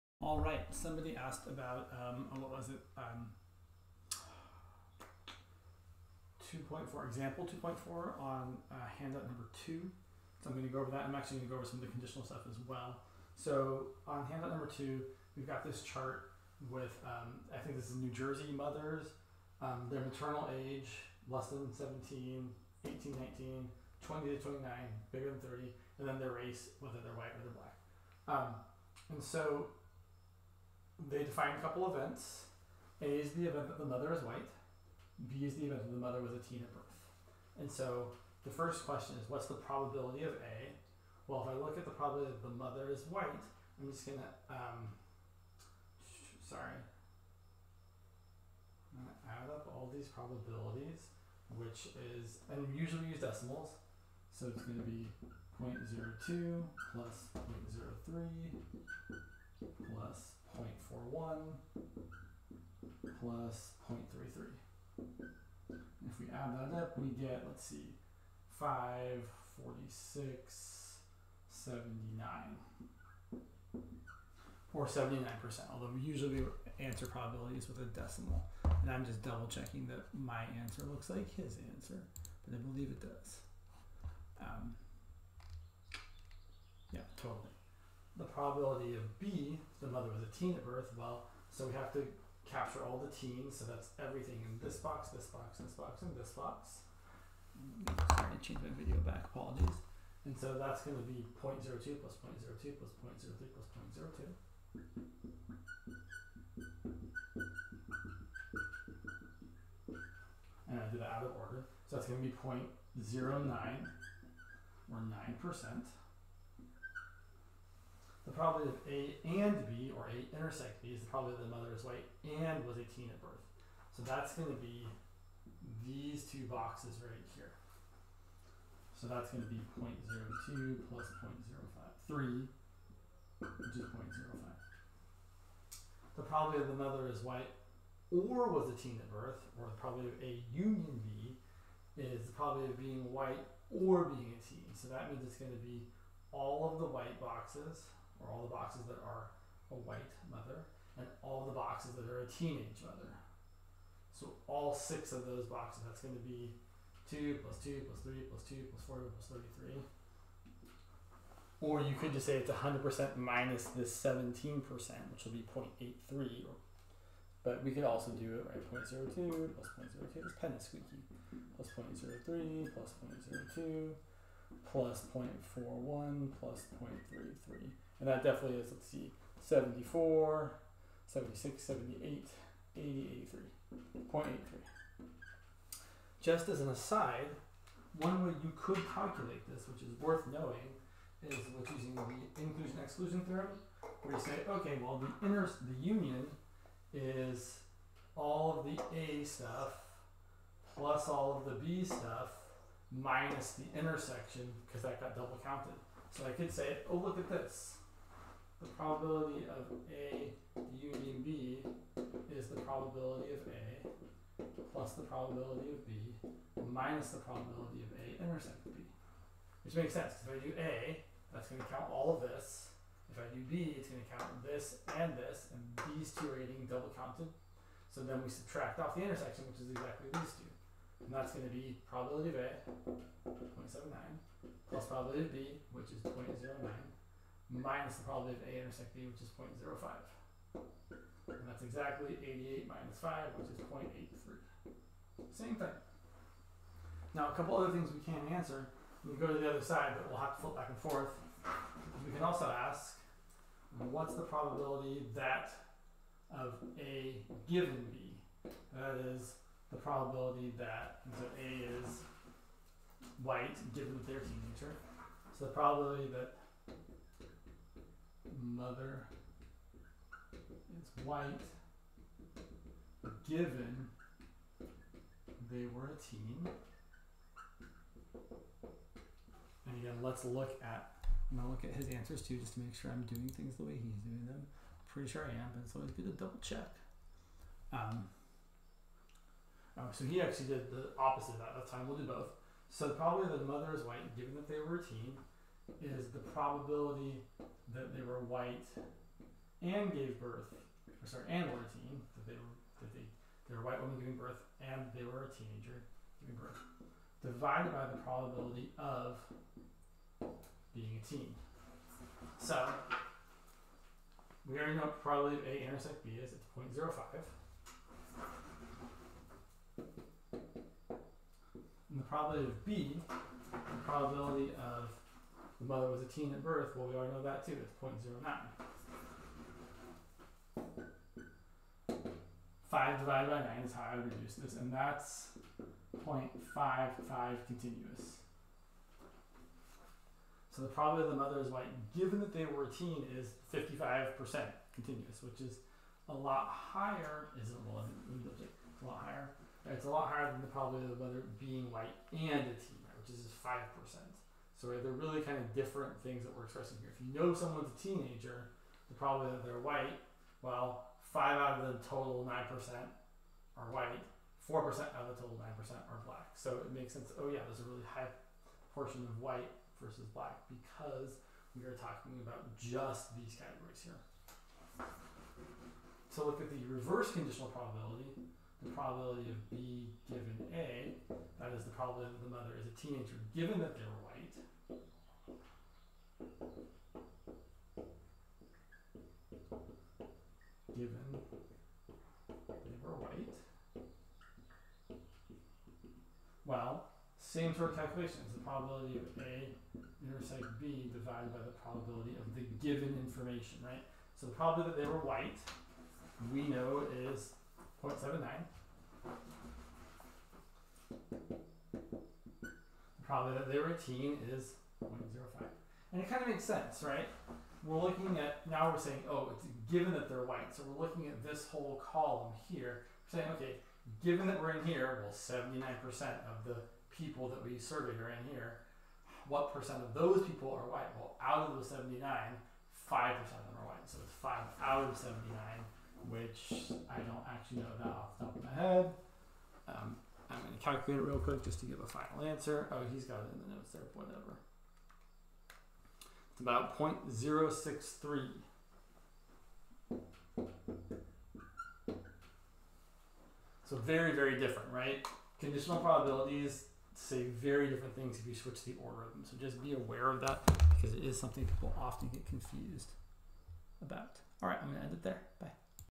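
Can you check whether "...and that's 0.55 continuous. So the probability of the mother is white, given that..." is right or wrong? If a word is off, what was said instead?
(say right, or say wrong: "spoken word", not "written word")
right.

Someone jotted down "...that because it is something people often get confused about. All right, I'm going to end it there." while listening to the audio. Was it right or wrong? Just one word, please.
right.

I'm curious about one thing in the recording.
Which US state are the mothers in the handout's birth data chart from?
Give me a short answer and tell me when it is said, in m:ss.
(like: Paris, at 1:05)
New Jersey, at 0:17.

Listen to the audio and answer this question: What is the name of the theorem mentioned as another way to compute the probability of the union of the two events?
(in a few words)
inclusion-exclusion theorem.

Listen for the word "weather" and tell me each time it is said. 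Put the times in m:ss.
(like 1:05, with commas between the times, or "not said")
5:51.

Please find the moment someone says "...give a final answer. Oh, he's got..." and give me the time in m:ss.
7:21.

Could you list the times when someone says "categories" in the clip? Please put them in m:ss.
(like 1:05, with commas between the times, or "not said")
6:13.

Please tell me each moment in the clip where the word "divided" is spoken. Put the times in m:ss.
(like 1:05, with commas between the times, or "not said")
5:07, 5:32, 6:40.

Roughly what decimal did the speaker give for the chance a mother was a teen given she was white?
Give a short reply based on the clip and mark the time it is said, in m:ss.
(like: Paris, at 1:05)
0.063, at 7:27.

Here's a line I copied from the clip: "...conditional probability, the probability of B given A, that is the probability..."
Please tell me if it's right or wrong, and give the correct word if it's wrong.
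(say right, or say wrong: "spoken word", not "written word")
right.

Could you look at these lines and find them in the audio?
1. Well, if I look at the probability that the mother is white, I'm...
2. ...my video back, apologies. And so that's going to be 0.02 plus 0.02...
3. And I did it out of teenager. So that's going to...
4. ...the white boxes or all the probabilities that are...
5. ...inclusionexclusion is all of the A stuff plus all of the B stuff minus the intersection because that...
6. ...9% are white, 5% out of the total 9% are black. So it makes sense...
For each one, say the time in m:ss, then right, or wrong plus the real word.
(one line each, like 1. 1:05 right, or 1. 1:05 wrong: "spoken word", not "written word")
1. 0:41 right
2. 1:38 right
3. 1:50 wrong: "order", not "teenager"
4. 2:26 wrong: "boxes", not "probabilities"
5. 3:15 wrong: "union", not "inclusionexclusion"
6. 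6:02 wrong: "4", not "5".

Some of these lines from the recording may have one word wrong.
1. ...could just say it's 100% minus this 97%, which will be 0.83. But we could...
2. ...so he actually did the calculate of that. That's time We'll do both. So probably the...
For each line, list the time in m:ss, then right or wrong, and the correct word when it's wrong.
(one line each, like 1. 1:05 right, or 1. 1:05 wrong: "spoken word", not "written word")
1. 2:41 wrong: "17", not "97"
2. 4:49 wrong: "opposite", not "calculate".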